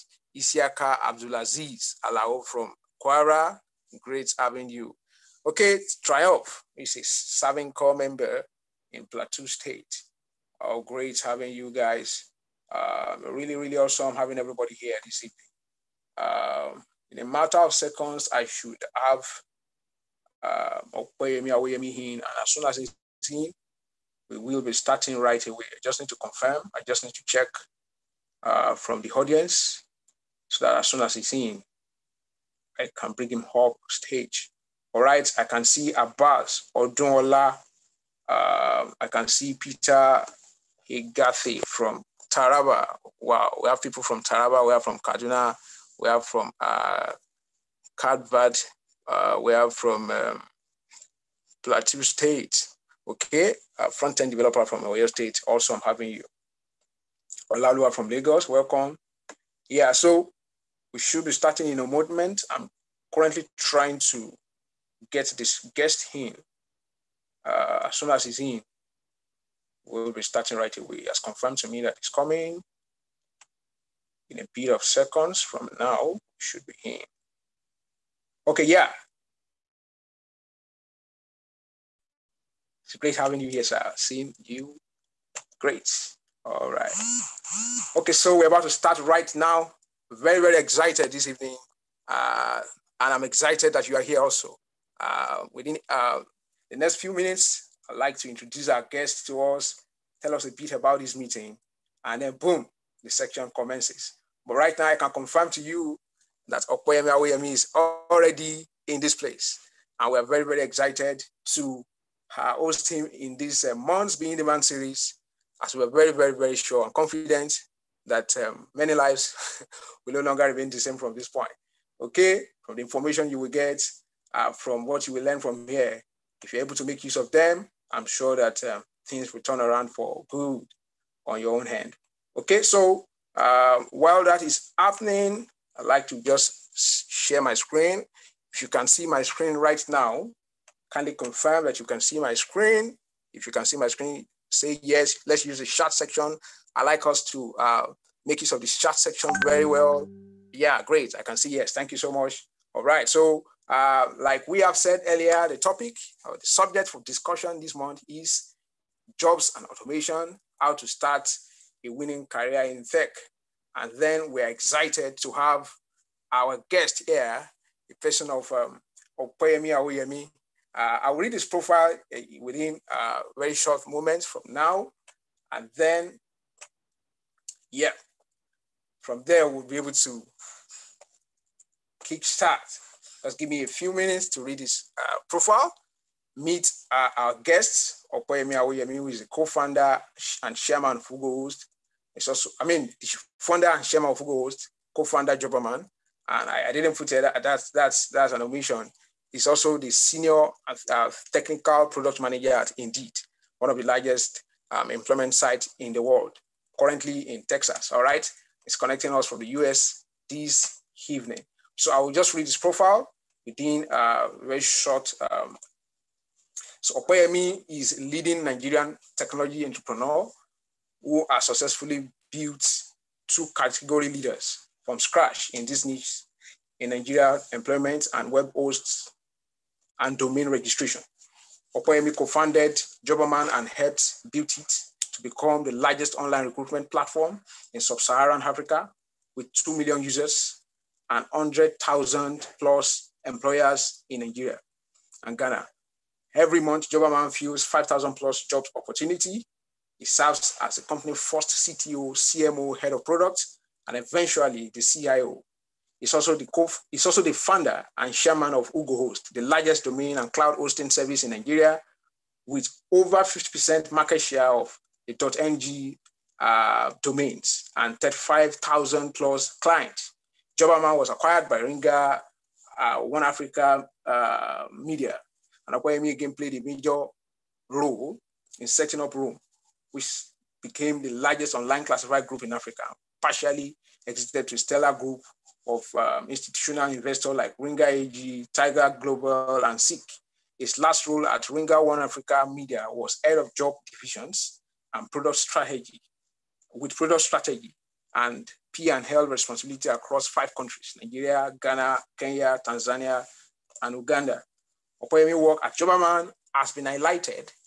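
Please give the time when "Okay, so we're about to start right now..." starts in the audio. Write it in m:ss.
1:27.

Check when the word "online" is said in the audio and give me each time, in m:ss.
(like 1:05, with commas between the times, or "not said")
3:56, 4:41.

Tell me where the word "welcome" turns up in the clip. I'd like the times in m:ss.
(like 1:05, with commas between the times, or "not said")
0:58.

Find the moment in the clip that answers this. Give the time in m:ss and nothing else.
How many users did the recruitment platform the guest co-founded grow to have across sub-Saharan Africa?
3:59.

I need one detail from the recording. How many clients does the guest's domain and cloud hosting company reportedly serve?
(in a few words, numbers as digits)
35,000 plus.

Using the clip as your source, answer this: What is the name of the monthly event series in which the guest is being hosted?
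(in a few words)
Be In Demand.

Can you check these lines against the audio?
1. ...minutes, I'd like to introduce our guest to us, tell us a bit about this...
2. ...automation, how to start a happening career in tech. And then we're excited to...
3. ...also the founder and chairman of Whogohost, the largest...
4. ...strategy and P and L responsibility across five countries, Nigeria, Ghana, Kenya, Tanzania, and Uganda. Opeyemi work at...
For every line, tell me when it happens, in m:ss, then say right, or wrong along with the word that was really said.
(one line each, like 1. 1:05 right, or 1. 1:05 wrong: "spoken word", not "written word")
1. 1:37 right
2. 2:39 wrong: "winning", not "happening"
3. 4:17 right
4. 4:57 right.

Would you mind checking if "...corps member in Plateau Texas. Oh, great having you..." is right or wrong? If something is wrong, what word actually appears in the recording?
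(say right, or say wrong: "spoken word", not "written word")
wrong: "State", not "Texas".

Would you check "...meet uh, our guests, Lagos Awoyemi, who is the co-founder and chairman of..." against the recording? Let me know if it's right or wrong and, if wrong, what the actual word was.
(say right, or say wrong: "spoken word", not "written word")
wrong: "Opeyemi", not "Lagos".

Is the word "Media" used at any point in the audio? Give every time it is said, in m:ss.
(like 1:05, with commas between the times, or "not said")
4:34, 4:52.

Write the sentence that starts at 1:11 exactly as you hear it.
He has confirmed to me that he's coming.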